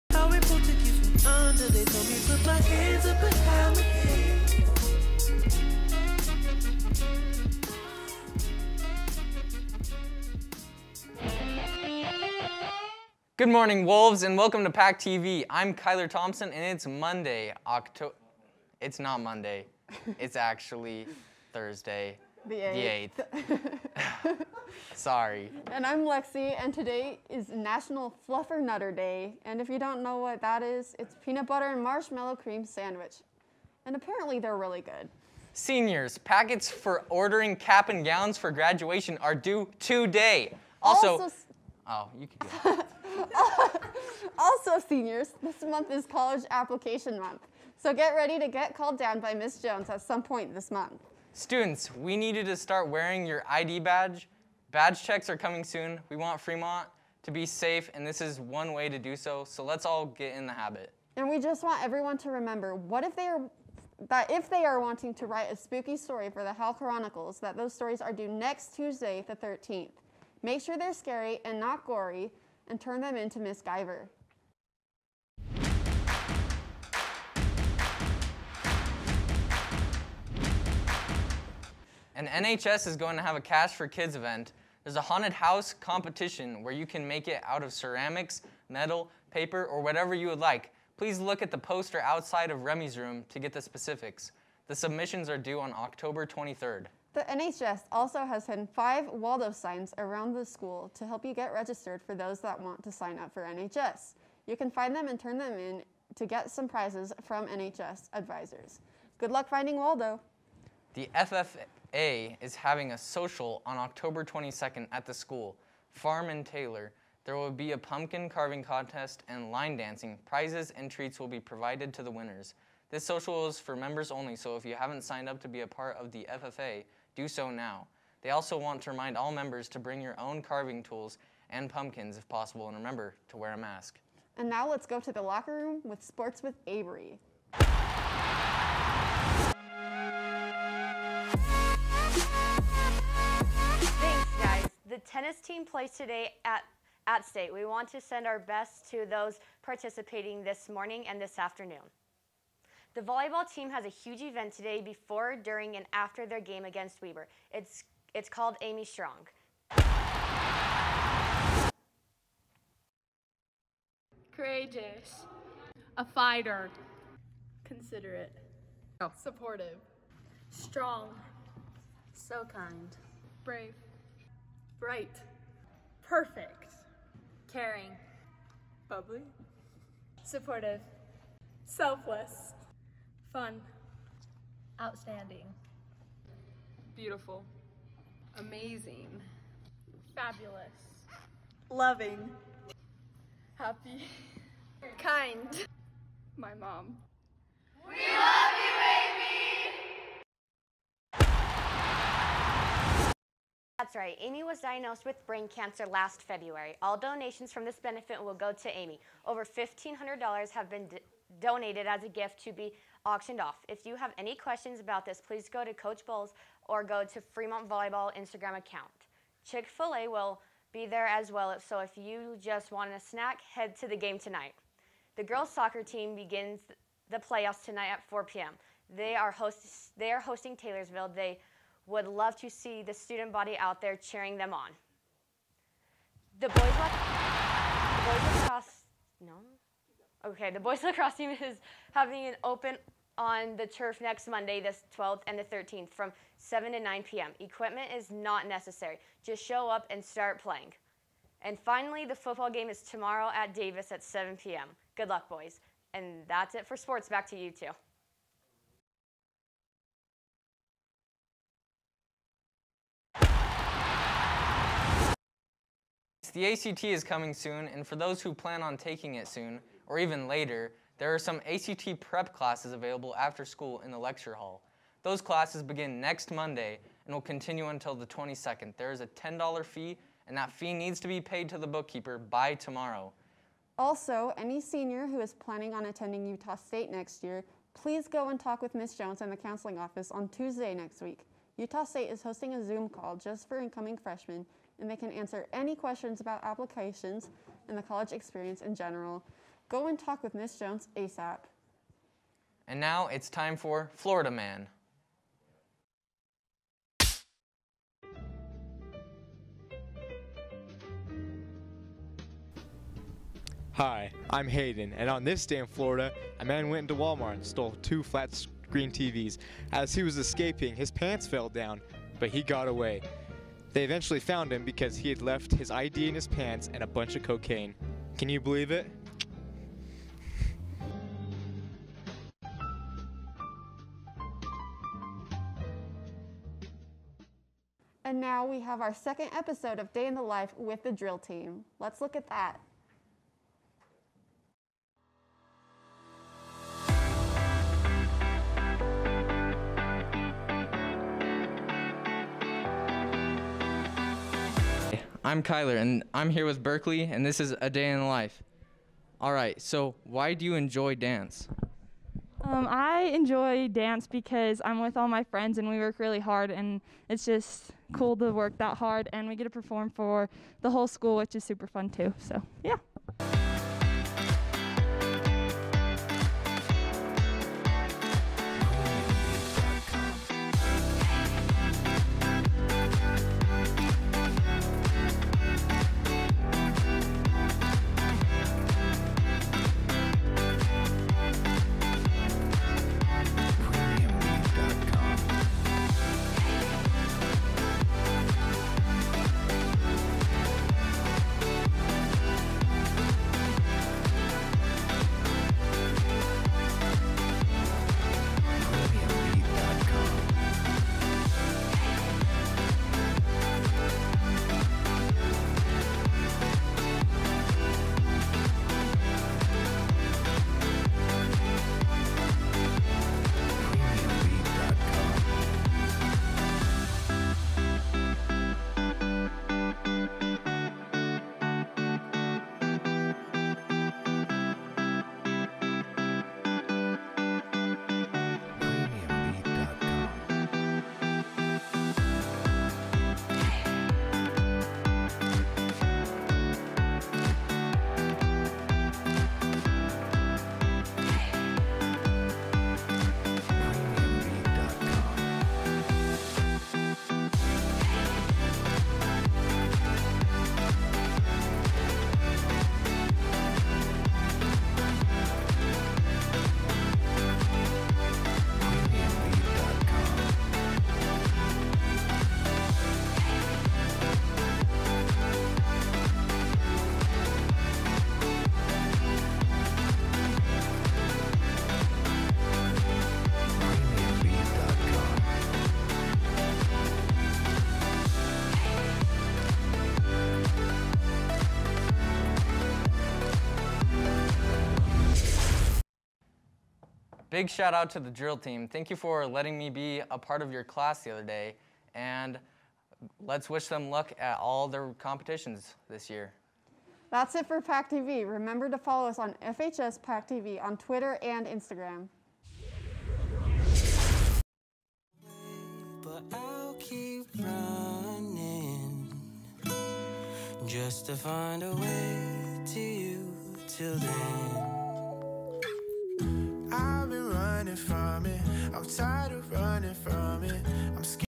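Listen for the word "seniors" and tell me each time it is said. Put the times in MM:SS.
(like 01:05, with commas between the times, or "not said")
00:35, 00:44, 04:44.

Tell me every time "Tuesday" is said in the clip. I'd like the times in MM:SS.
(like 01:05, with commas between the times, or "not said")
01:08, 04:50.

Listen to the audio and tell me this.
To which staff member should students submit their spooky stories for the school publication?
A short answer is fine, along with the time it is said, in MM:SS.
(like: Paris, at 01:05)
Miss Giver, at 01:13.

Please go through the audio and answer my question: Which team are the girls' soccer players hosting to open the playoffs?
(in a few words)
Taylorsville.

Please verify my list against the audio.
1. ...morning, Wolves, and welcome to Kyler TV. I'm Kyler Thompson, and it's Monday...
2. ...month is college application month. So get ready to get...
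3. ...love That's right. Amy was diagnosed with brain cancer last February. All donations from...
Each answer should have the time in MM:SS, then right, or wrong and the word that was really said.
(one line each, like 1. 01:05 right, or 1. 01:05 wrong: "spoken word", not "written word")
1. 00:13 wrong: "Pack", not "Kyler"
2. 00:45 right
3. 03:17 right.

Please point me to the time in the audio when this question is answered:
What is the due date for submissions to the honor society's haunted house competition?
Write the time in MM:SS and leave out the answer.
01:35.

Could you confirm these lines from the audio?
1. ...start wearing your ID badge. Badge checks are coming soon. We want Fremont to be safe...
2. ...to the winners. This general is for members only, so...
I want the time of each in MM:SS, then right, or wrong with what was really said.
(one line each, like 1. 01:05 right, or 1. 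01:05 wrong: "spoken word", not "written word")
1. 00:52 right
2. 02:01 wrong: "social", not "general".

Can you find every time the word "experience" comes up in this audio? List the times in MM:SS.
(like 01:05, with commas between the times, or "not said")
04:58.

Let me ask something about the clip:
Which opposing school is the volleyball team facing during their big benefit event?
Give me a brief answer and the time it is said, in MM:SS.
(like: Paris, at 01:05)
Weber, at 02:37.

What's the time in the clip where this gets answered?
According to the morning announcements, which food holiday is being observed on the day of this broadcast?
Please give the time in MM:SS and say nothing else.
00:27.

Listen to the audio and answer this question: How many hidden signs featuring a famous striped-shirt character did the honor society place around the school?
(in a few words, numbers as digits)
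5.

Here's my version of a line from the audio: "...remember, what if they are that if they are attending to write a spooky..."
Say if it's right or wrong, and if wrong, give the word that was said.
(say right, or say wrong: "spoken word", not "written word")
wrong: "wanting", not "attending".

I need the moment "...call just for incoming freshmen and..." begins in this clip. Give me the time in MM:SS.
04:52.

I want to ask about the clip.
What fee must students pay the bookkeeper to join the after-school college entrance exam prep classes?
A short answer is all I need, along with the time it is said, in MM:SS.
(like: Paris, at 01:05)
$10, at 04:39.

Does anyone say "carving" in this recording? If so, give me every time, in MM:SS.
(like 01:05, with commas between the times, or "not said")
01:58, 02:10.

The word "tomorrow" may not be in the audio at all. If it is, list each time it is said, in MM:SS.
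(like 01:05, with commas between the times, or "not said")
04:12, 04:42.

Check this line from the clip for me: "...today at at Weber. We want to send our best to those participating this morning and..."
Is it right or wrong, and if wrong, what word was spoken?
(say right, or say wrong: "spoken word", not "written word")
wrong: "State", not "Weber".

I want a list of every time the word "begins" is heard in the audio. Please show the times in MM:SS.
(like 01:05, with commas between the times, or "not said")
03:46, 04:35.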